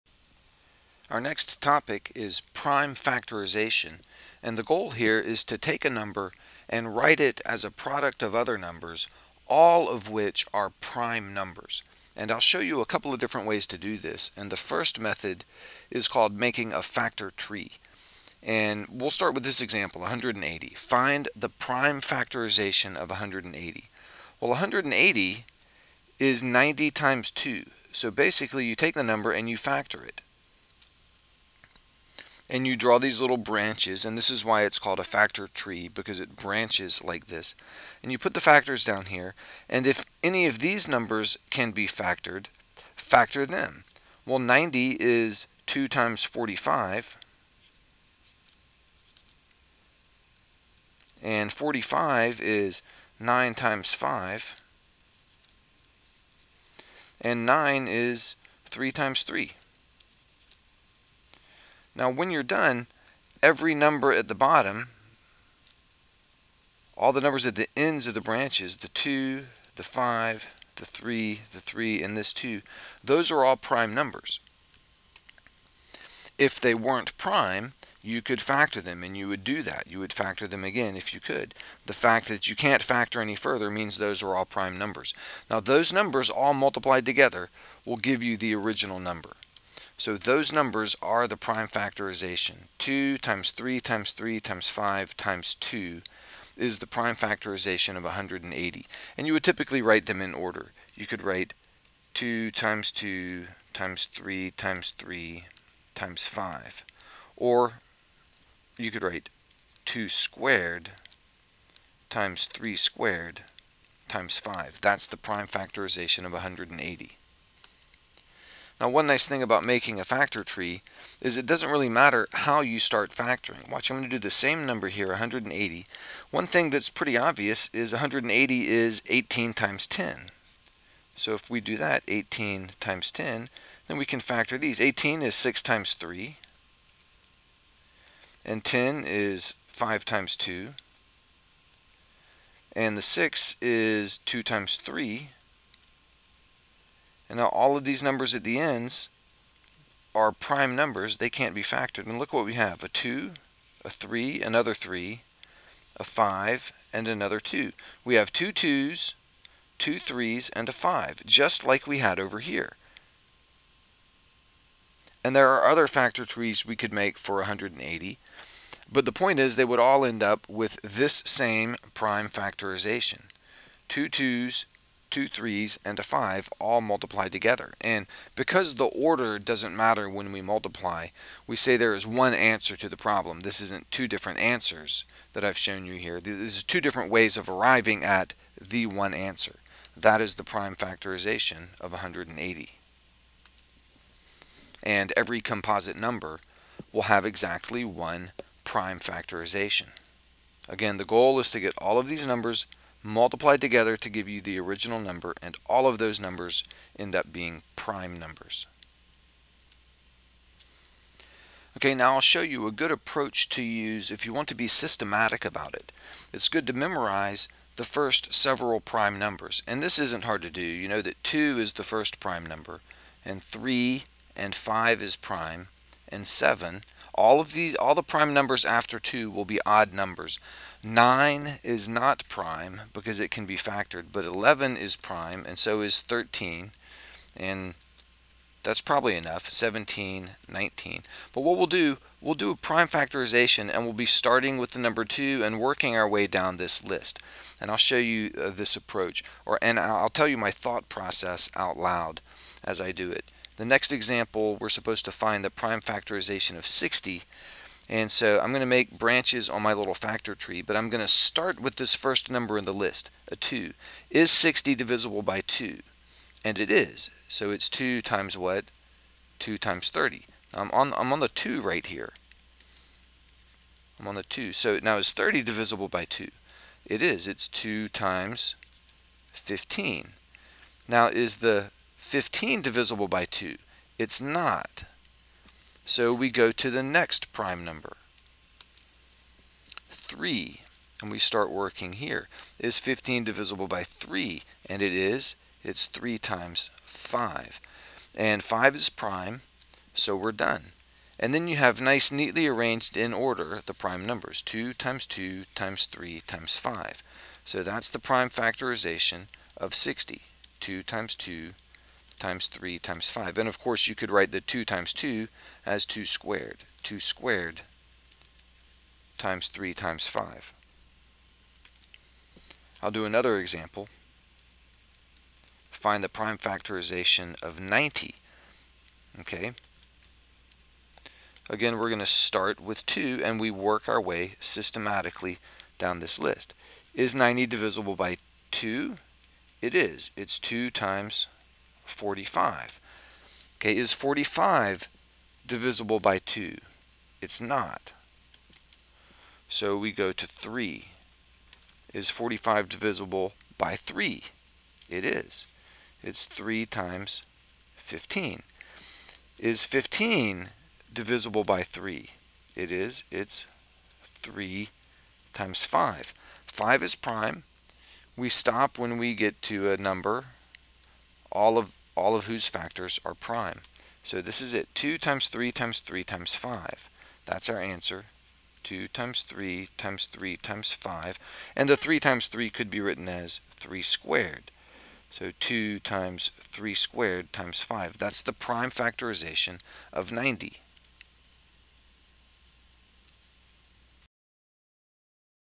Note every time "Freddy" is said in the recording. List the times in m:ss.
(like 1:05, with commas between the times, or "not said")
not said.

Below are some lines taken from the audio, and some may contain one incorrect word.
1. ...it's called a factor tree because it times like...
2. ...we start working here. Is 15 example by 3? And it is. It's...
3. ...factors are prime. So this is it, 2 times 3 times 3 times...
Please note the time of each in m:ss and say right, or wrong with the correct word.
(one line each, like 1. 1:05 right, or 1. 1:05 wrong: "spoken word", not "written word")
1. 0:34 wrong: "branches", not "times"
2. 4:51 wrong: "divisible", not "example"
3. 6:12 right.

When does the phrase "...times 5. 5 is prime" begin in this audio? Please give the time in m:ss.
6:05.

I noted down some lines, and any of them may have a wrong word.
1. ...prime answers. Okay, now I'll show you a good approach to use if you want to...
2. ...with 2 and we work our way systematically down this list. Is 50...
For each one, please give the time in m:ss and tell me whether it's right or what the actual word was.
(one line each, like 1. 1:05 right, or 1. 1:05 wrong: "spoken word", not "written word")
1. 3:27 wrong: "numbers", not "answers"
2. 5:32 wrong: "90", not "50".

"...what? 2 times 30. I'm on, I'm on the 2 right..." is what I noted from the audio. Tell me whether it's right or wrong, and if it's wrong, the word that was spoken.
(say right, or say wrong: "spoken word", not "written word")
right.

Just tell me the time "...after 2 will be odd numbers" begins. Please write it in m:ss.
3:48.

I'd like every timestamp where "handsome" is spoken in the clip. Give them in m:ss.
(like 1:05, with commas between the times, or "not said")
not said.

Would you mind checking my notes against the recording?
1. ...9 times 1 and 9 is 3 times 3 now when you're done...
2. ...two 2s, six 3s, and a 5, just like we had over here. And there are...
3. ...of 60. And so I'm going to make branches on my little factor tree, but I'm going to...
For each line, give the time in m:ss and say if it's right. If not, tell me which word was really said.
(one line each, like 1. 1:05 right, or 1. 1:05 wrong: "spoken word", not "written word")
1. 0:53 wrong: "5", not "1"
2. 2:38 wrong: "two", not "six"
3. 4:16 right.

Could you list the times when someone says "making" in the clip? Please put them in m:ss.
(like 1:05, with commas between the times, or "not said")
0:16, 1:59.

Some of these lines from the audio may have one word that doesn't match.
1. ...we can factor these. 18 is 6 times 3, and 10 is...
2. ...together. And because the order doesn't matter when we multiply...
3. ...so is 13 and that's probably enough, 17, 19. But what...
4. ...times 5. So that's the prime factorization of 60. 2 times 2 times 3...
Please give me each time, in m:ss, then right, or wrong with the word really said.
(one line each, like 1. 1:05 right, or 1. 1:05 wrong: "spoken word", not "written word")
1. 2:13 right
2. 2:57 right
3. 3:55 right
4. 5:06 right.